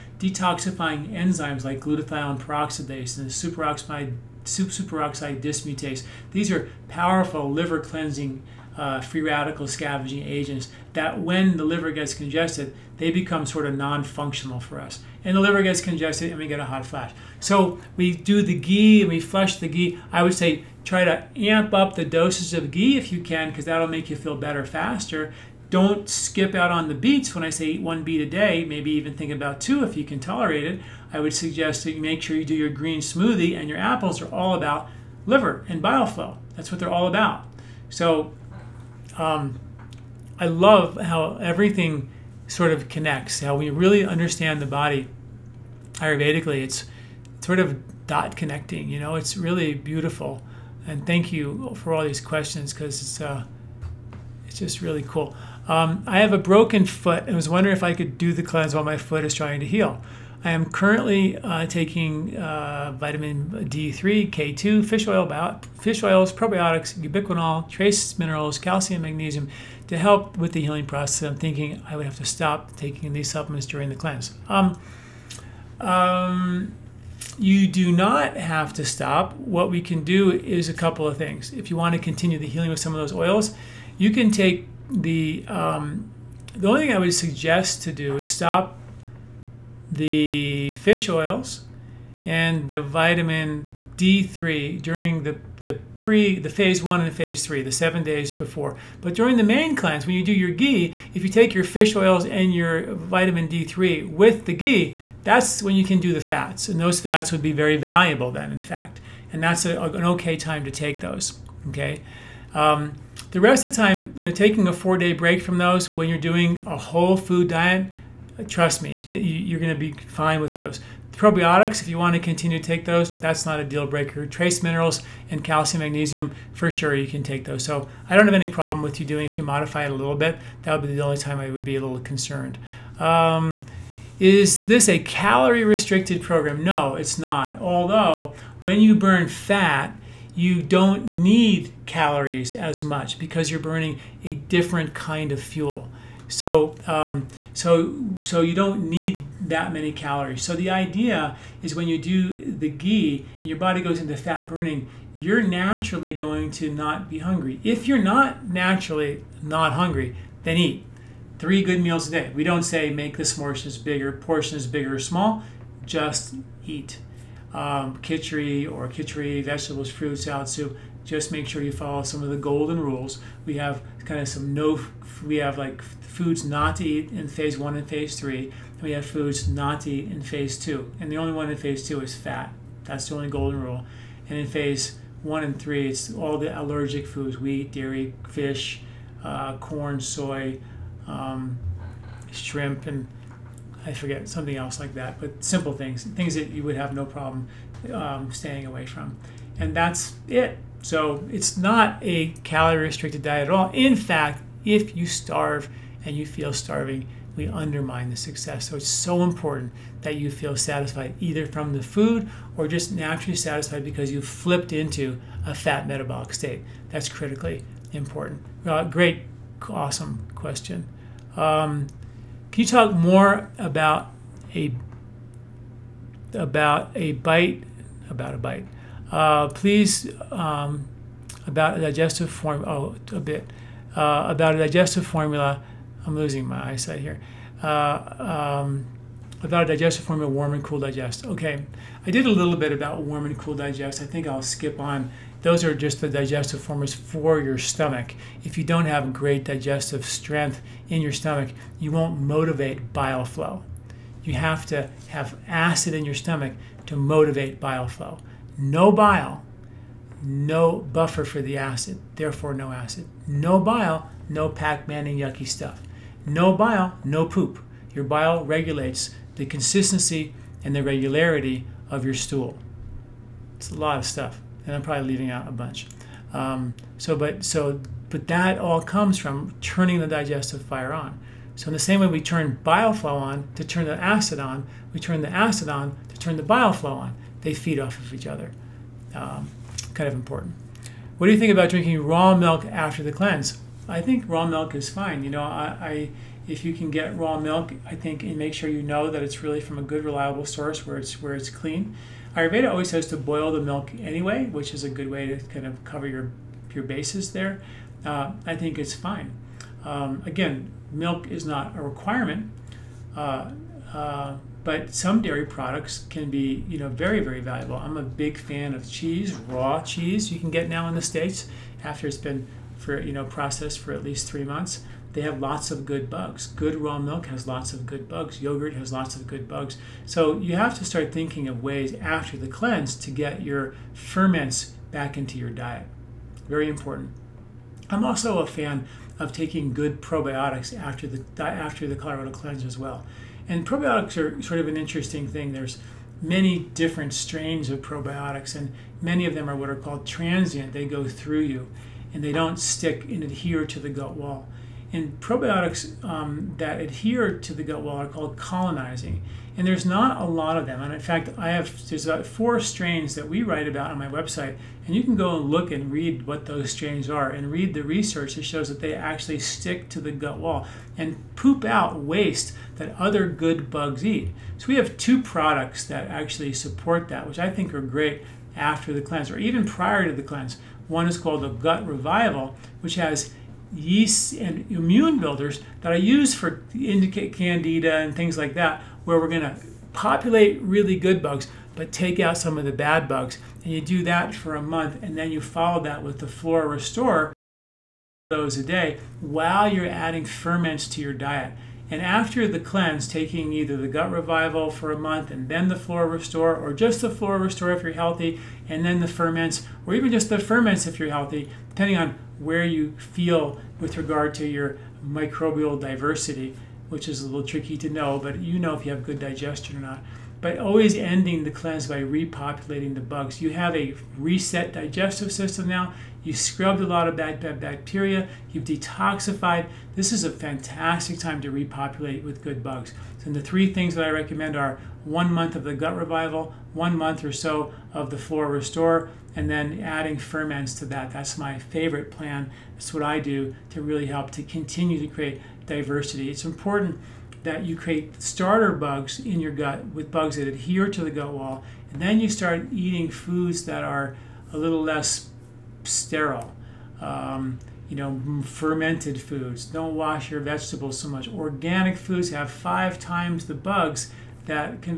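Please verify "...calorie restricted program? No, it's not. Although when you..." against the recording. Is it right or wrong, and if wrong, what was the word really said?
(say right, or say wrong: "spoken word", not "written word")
right.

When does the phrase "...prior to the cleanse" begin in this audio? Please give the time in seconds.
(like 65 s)
379 s.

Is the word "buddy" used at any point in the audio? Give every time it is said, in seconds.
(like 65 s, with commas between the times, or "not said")
not said.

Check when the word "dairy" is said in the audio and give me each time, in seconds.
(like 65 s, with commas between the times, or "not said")
187 s, 315 s.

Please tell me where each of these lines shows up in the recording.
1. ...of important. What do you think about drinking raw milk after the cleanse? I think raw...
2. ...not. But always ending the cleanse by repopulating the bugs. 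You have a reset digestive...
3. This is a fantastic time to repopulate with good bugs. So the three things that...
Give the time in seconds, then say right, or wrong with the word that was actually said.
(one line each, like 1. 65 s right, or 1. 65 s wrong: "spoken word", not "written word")
1. 290 s right
2. 419 s right
3. 429 s right.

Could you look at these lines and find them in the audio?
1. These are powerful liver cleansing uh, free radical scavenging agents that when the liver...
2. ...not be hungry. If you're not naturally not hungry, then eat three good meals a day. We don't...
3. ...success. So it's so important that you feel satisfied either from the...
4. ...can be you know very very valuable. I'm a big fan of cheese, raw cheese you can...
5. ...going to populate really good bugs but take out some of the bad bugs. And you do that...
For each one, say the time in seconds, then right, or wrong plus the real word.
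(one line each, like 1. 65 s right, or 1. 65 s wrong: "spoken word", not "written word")
1. 6 s right
2. 156 s right
3. 208 s right
4. 316 s right
5. 389 s right.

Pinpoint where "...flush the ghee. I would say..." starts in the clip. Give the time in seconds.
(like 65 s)
19 s.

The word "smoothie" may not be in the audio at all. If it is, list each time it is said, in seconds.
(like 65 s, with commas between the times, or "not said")
33 s.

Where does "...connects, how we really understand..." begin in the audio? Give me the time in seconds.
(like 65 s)
42 s.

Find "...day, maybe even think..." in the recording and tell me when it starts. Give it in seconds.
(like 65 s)
28 s.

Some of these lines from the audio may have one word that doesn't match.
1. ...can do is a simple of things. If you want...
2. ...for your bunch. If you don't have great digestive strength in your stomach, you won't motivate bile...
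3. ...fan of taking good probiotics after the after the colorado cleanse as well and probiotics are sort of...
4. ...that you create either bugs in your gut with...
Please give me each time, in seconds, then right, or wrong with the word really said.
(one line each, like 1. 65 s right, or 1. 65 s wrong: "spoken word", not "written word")
1. 79 s wrong: "couple", not "simple"
2. 246 s wrong: "stomach", not "bunch"
3. 338 s right
4. 447 s wrong: "starter", not "either".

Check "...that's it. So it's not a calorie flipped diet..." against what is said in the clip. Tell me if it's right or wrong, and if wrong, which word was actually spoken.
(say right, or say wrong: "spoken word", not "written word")
wrong: "restricted", not "flipped".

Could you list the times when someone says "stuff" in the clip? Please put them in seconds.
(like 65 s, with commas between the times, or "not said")
265 s, 274 s.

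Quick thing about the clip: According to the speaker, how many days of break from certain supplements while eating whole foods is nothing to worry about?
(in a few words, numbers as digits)
4.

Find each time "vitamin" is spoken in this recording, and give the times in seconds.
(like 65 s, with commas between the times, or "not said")
62 s, 92 s, 102 s.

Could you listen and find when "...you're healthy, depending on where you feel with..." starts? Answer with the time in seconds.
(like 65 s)
410 s.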